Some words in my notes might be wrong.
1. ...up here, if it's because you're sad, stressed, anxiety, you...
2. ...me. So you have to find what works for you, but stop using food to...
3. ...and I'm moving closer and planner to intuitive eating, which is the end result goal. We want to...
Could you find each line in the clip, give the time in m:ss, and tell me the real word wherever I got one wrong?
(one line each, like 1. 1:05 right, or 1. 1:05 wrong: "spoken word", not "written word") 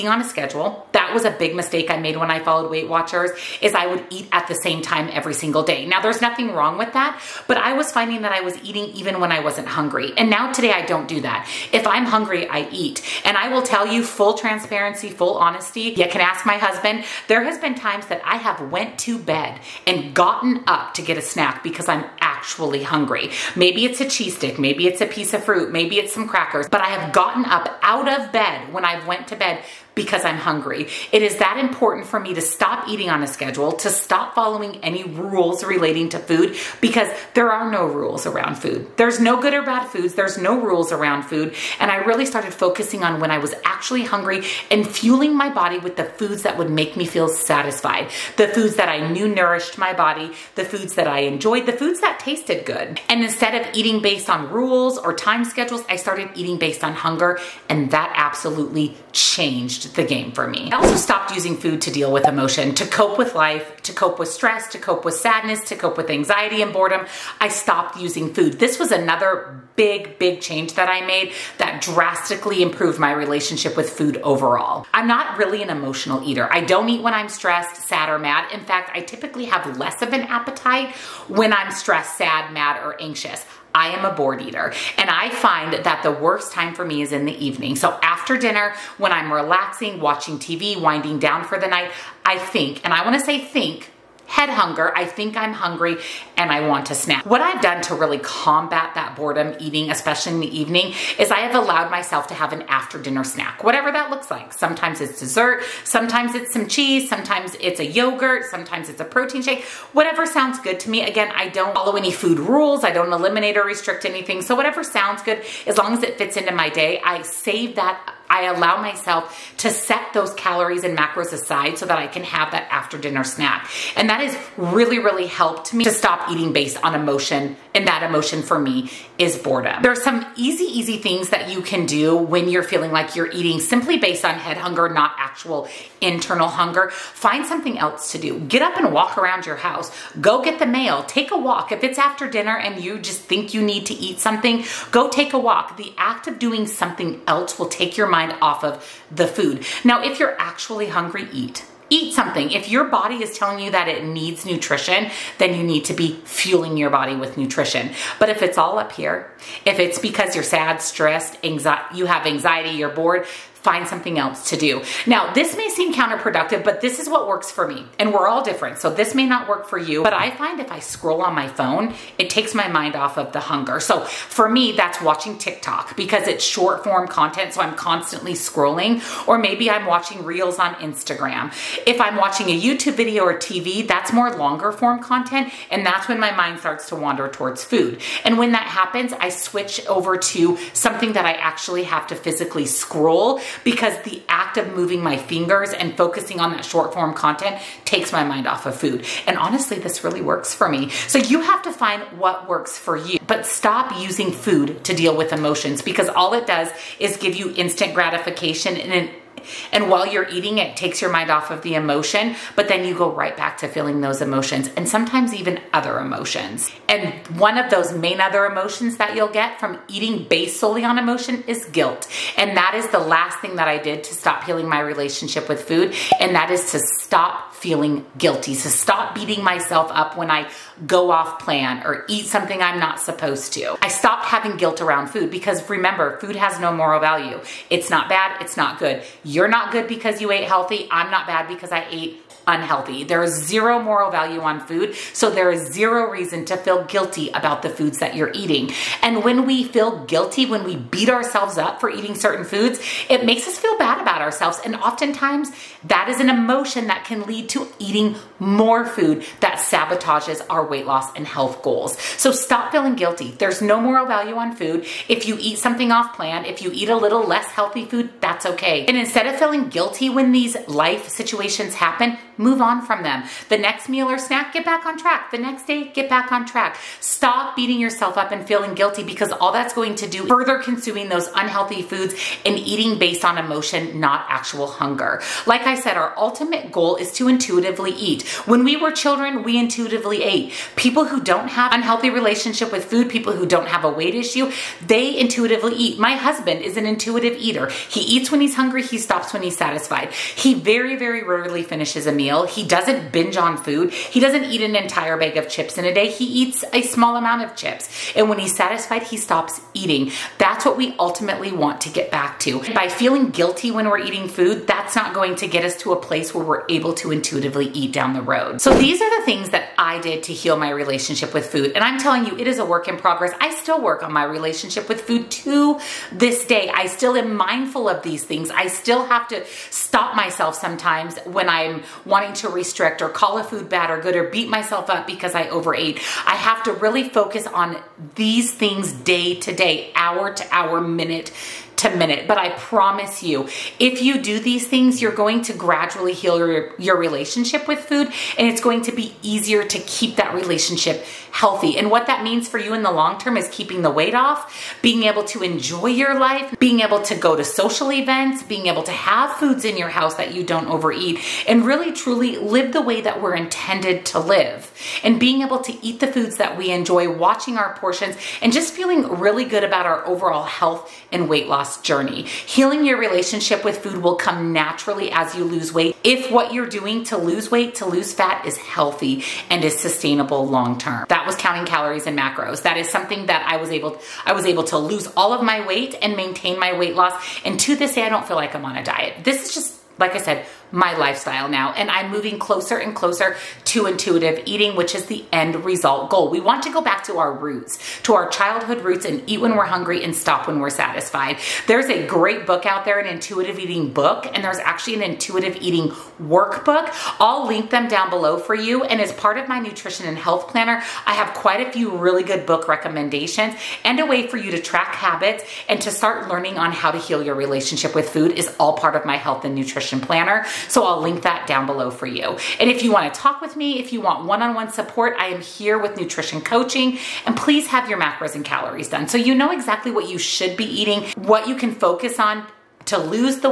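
1. 2:38 right
2. 3:20 right
3. 6:31 wrong: "closer", not "planner".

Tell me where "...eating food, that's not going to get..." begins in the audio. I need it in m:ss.
5:14.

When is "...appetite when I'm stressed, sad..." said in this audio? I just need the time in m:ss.
1:20.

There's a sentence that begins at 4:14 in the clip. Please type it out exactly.
And oftentimes, that is an emotion that can lead to eating more food that sabotages our weight loss and health goals.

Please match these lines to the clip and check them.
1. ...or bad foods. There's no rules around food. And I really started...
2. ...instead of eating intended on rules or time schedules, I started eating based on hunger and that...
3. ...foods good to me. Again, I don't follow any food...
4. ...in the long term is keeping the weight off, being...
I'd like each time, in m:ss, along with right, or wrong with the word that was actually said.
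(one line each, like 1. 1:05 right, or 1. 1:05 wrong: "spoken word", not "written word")
1. 0:39 right
2. 0:53 wrong: "based", not "intended"
3. 1:50 wrong: "sounds", not "foods"
4. 5:52 right.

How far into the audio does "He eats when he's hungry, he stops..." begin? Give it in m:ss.
4:57.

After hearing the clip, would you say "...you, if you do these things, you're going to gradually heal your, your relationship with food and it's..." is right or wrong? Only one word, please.
right.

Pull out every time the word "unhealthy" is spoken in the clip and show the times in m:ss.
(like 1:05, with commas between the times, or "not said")
4:02, 4:41, 4:51.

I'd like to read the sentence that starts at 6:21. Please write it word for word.
That was counting calories and macros.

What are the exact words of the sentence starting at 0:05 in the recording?
Now there's nothing wrong with that, but I was finding that I was eating even when I wasn't hungry.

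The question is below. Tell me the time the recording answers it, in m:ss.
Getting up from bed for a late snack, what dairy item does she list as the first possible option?
0:24.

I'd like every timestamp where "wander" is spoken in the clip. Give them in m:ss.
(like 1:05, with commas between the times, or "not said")
3:06.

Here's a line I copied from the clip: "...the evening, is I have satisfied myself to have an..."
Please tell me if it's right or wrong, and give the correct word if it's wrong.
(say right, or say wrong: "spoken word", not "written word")
wrong: "allowed", not "satisfied".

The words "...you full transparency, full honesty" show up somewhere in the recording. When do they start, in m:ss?
0:13.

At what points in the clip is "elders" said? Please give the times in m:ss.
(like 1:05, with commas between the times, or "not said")
not said.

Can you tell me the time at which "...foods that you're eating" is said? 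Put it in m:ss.
4:07.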